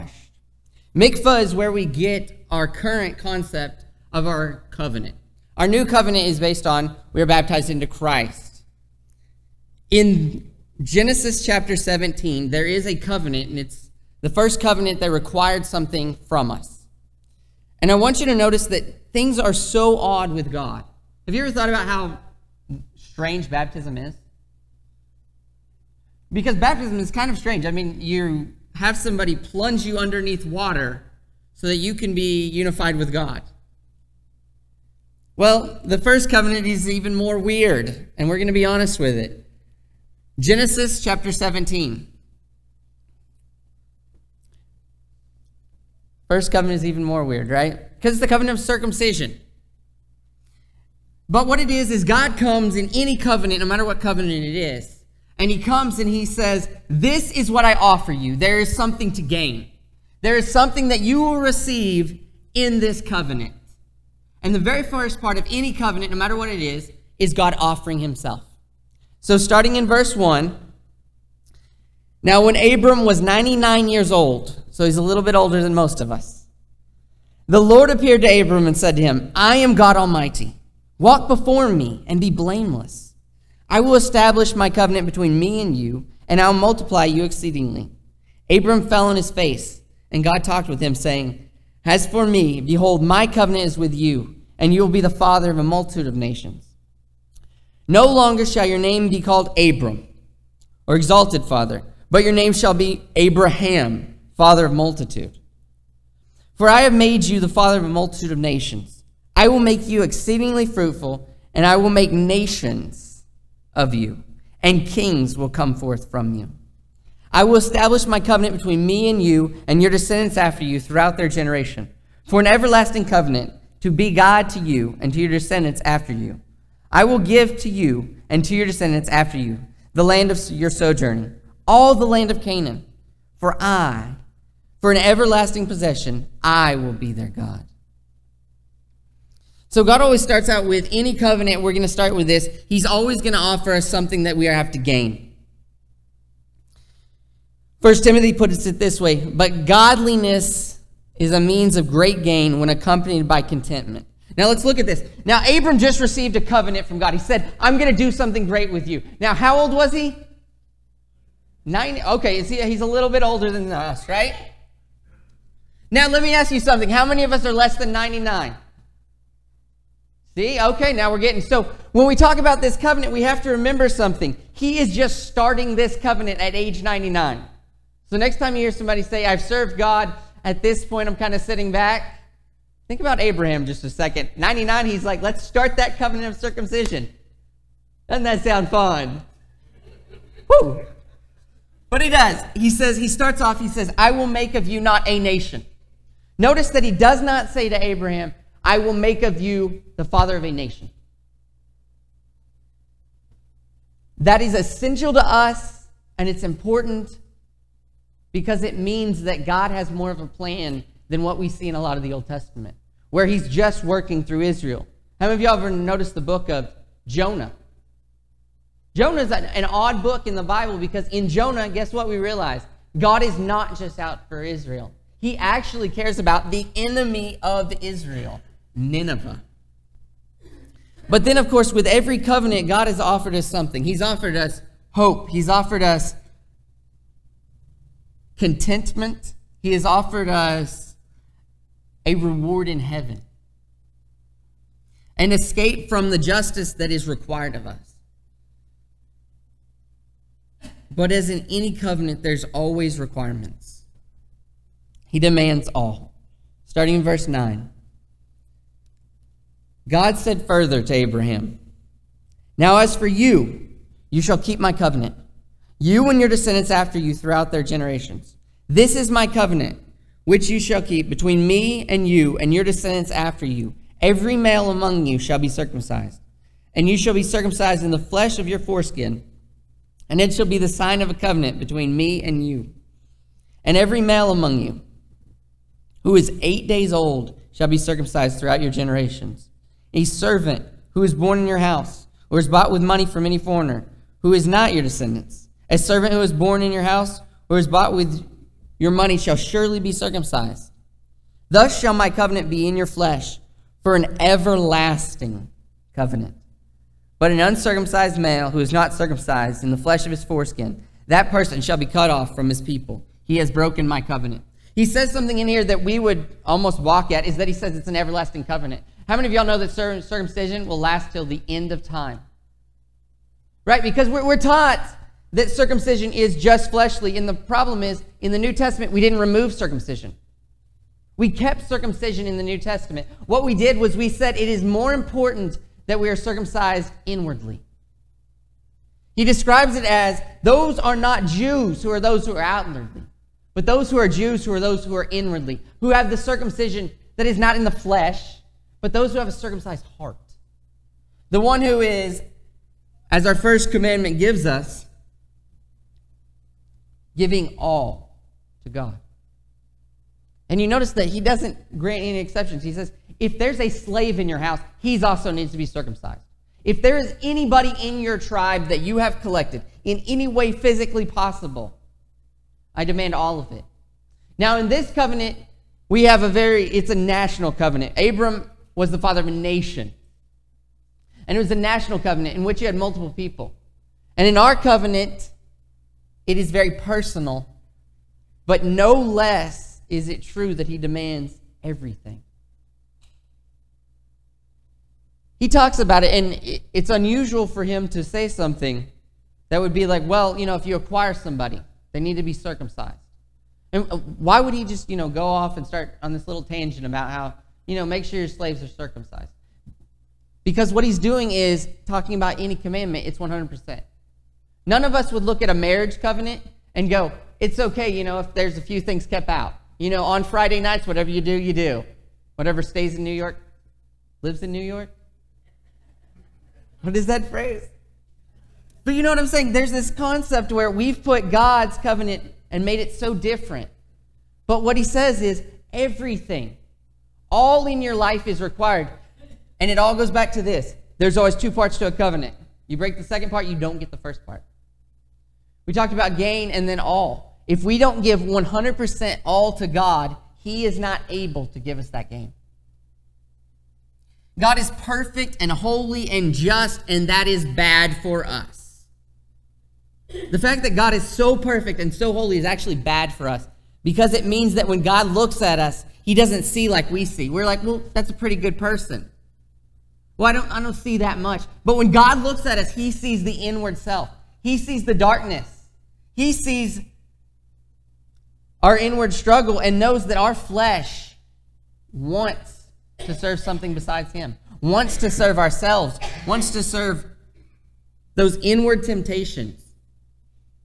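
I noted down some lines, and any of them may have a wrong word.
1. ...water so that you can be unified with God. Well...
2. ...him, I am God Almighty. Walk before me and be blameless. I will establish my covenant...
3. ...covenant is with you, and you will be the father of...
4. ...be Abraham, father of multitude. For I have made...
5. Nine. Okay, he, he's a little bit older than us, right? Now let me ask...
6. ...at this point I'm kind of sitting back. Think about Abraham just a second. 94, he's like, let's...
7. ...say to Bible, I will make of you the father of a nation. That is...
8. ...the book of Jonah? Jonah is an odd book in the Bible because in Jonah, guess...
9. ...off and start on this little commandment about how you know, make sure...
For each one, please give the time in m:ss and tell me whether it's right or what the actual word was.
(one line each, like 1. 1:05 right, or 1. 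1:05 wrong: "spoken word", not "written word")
1. 0:30 right
2. 1:19 right
3. 1:33 right
4. 1:42 right
5. 2:41 right
6. 3:00 wrong: "99", not "94"
7. 3:17 wrong: "Abraham", not "Bible"
8. 3:36 right
9. 6:45 wrong: "tangent", not "commandment".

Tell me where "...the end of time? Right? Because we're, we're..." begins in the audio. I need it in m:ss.
5:21.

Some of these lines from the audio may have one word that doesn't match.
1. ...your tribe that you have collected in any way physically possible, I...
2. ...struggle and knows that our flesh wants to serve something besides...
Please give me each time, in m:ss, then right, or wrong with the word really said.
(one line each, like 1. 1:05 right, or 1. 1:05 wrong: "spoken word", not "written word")
1. 6:07 right
2. 7:59 right.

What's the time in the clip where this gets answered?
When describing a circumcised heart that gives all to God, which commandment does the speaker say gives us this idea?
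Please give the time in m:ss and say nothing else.
5:53.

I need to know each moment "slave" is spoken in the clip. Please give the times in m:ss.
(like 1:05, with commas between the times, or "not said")
6:03, 6:48.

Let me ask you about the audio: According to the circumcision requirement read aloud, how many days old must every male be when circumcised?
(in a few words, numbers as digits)
8.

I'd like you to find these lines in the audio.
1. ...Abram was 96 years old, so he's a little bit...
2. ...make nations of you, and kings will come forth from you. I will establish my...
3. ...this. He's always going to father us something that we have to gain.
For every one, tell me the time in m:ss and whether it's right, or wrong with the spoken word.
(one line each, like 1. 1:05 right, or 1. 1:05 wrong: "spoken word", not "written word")
1. 1:12 wrong: "99", not "96"
2. 1:51 right
3. 2:22 wrong: "offer", not "father".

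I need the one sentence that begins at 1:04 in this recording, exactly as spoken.
And the very first part of any covenant, no matter what it is, is God offering Himself.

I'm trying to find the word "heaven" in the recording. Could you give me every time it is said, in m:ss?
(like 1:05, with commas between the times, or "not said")
4:02.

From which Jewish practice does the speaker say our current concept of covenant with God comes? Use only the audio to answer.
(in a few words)
Mikvah.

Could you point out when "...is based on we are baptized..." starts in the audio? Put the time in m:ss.
0:06.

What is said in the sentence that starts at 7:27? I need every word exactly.
If we don't give 100% all to God, He is not able to give us that gain.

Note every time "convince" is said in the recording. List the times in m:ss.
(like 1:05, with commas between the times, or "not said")
not said.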